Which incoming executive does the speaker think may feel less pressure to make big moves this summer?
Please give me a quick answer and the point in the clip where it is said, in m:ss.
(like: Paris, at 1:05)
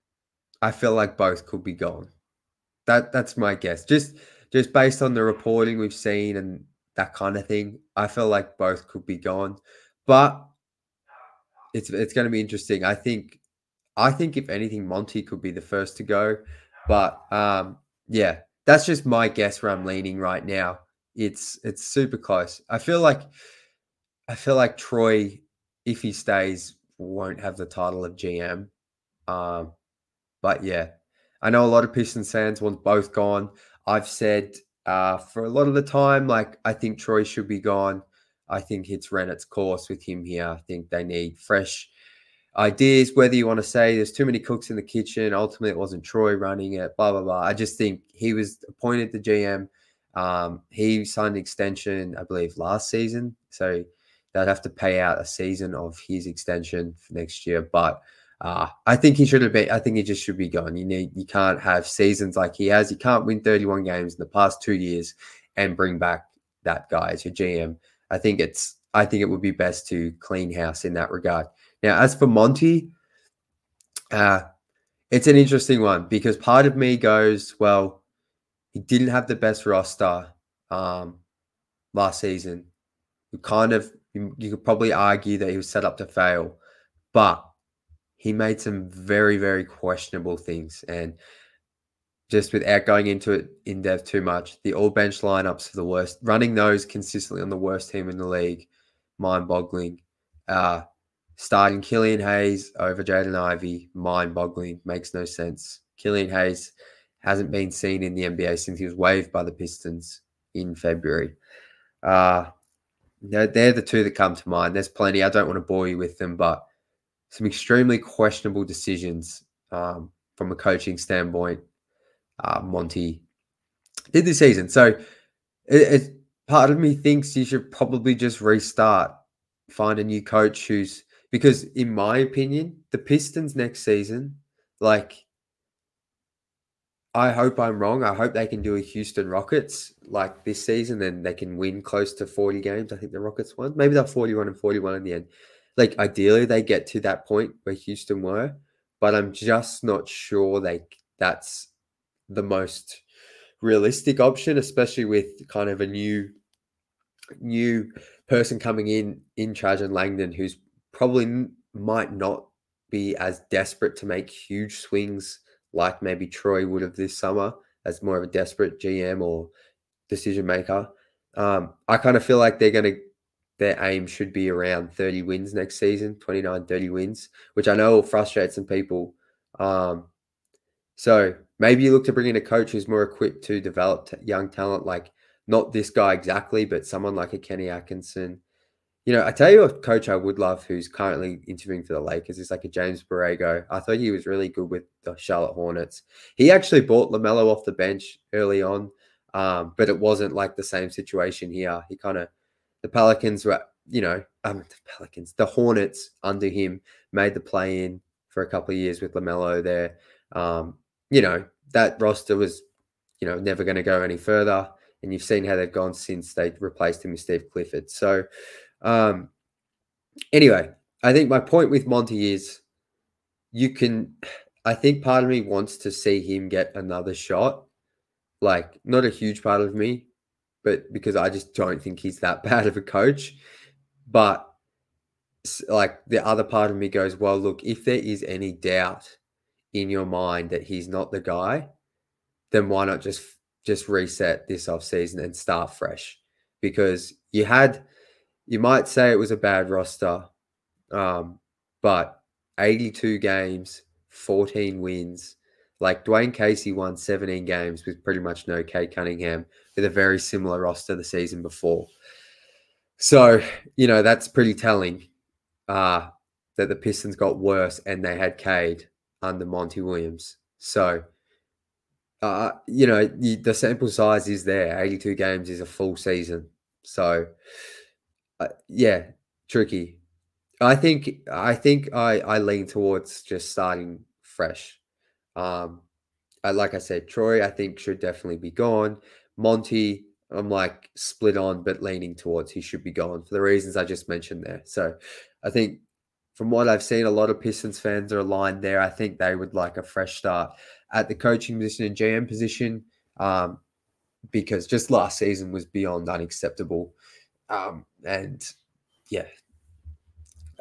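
Trajan Langdon, at 2:39.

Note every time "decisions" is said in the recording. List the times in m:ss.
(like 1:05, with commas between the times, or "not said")
1:58, 2:50.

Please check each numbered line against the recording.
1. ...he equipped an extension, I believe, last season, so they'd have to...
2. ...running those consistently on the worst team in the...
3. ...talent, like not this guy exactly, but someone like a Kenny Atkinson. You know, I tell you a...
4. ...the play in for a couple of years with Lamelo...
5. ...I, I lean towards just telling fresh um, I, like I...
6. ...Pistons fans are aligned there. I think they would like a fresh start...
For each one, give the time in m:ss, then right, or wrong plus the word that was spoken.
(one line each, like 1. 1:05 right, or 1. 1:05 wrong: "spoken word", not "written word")
1. 0:50 wrong: "signed", not "equipped"
2. 1:36 right
3. 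3:04 right
4. 3:27 right
5. 4:41 wrong: "starting", not "telling"
6. 4:57 right.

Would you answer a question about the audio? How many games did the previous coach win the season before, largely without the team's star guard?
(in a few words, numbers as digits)
17.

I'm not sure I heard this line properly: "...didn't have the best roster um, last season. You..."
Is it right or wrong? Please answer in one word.
right.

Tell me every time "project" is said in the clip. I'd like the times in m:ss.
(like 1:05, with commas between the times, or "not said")
not said.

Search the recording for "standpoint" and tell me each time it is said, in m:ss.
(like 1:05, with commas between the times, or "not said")
2:00.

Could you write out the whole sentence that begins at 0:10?
But it's it's going to be interesting.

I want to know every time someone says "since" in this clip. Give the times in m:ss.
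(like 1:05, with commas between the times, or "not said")
1:48, 3:35.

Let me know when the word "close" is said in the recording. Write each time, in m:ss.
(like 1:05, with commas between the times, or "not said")
0:22, 2:21.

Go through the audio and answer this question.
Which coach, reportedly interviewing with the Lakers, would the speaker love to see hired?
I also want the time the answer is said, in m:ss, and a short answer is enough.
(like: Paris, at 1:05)
James Borrego, at 3:12.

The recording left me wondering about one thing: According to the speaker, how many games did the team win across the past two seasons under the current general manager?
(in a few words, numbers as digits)
31.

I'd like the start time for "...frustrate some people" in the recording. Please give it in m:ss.
2:58.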